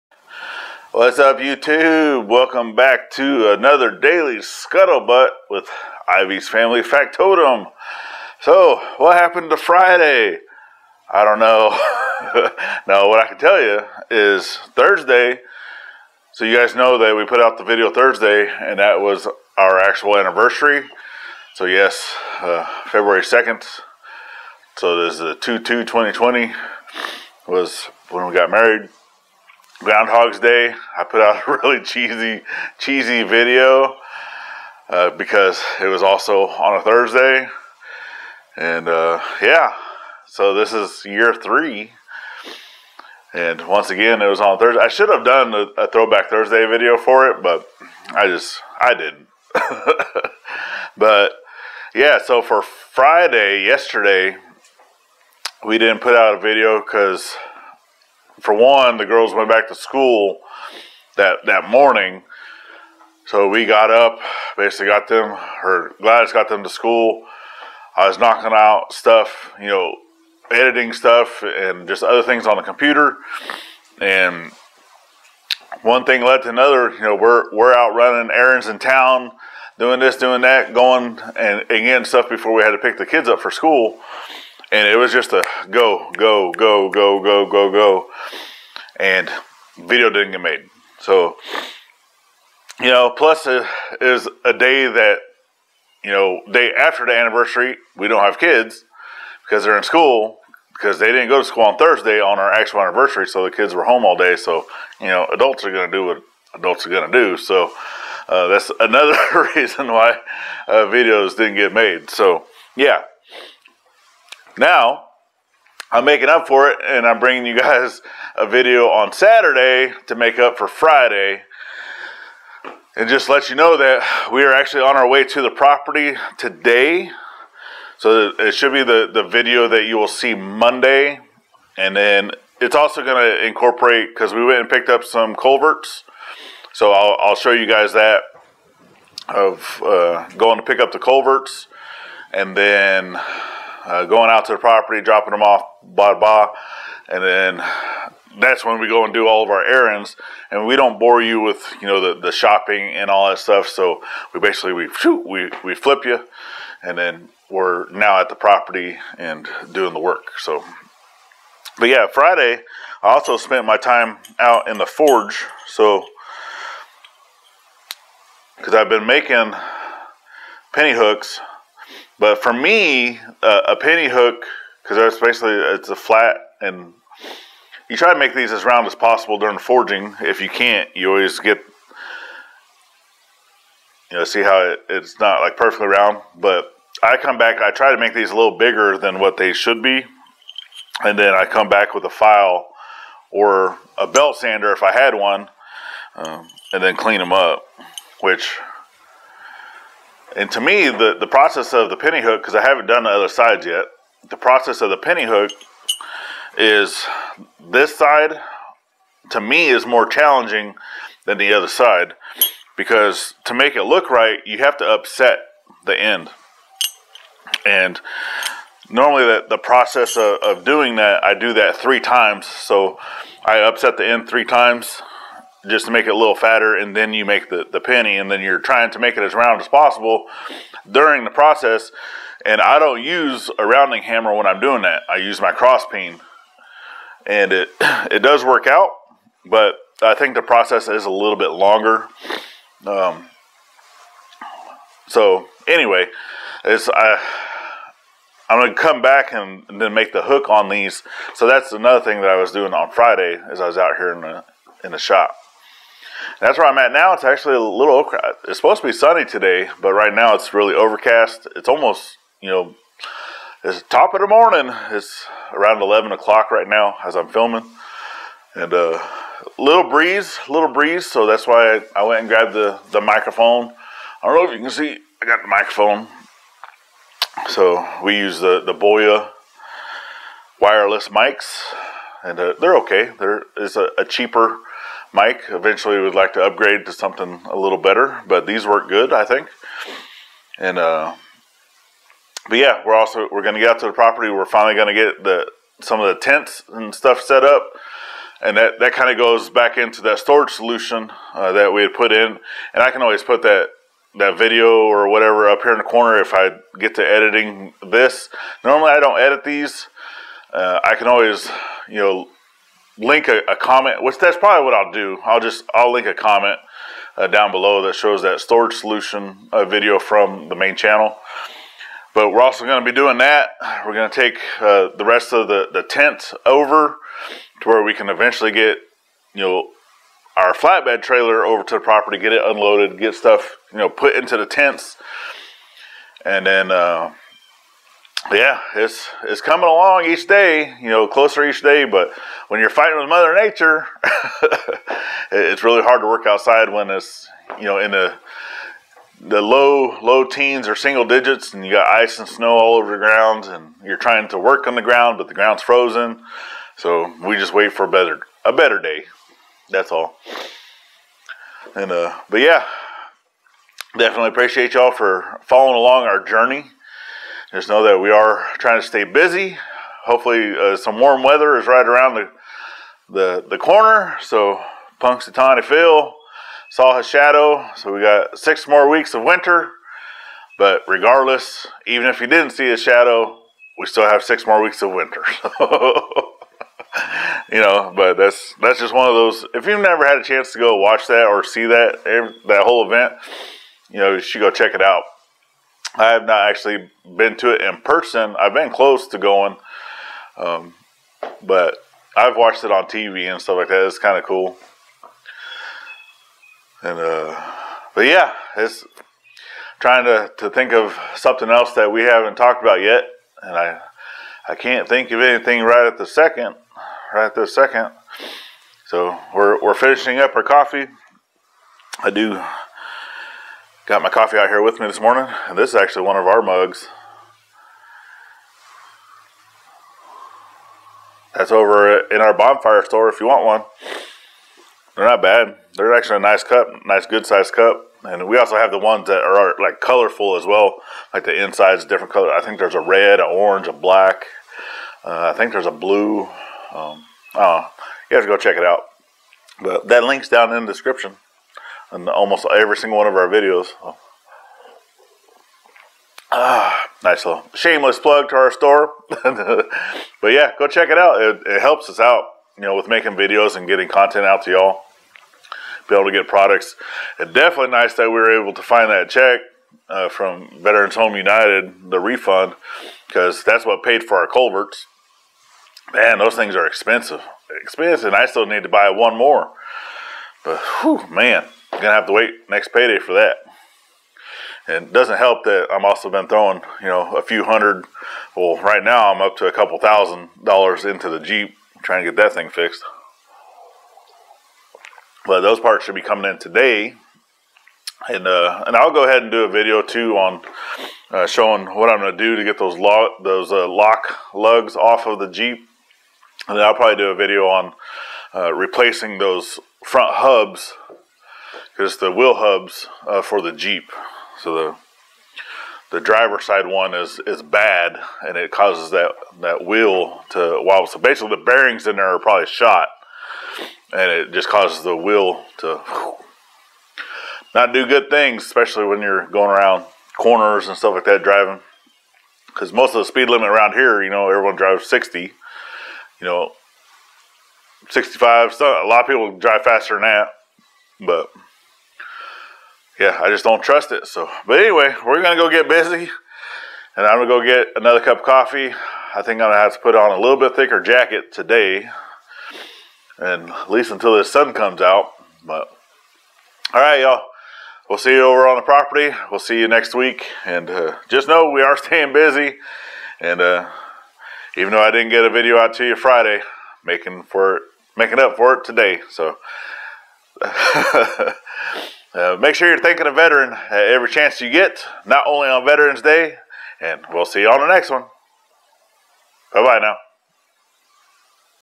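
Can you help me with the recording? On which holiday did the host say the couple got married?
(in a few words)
Groundhog's Day.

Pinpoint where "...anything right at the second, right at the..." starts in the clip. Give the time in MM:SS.
06:55.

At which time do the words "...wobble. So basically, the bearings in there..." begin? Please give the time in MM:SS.
08:40.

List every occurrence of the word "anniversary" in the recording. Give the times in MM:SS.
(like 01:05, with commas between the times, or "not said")
00:20, 01:37, 01:42.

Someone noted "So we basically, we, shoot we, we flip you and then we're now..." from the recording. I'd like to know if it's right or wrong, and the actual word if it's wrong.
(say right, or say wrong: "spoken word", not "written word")
right.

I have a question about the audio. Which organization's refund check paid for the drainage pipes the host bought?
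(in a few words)
Veterans Home United.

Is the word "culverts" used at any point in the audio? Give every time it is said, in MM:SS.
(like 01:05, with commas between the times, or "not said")
02:15, 02:20, 07:54.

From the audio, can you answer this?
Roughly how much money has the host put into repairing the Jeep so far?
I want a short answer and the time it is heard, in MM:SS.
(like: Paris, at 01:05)
a couple thousand dollars, at 08:09.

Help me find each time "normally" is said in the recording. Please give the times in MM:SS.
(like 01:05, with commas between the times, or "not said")
03:38, 05:08.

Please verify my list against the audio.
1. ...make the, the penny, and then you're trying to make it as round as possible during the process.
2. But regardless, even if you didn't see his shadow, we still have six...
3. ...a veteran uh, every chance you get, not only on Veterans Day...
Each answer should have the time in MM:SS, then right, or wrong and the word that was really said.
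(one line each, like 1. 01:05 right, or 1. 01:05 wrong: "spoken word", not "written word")
1. 03:47 right
2. 06:20 right
3. 09:33 right.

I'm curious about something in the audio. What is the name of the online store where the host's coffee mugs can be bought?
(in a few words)
bonfire.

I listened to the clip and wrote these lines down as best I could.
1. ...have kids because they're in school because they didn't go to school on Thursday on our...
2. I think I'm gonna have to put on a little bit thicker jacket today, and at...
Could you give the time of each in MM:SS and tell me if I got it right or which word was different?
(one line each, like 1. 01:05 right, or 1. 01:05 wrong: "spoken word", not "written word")
1. 01:38 right
2. 09:09 right.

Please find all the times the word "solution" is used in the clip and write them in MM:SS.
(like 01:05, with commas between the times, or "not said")
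05:00, 05:18.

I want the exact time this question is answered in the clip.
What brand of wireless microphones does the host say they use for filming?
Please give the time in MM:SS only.
04:38.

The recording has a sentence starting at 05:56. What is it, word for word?
So we just wait for a better a better day.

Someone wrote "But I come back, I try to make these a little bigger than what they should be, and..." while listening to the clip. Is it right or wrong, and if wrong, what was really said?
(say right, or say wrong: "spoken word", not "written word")
right.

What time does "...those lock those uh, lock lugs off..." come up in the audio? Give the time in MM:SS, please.
08:22.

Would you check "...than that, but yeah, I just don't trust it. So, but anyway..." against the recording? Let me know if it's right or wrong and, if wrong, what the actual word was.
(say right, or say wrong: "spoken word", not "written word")
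right.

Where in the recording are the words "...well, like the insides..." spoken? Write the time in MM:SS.
07:20.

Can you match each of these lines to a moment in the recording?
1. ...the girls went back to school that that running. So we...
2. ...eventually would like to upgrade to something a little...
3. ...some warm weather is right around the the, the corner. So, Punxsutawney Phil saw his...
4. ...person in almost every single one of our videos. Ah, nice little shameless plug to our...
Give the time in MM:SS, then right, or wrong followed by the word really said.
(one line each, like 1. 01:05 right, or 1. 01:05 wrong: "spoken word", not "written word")
1. 00:58 wrong: "morning", not "running"
2. 04:45 right
3. 06:10 right
4. 07:30 wrong: "description", not "person".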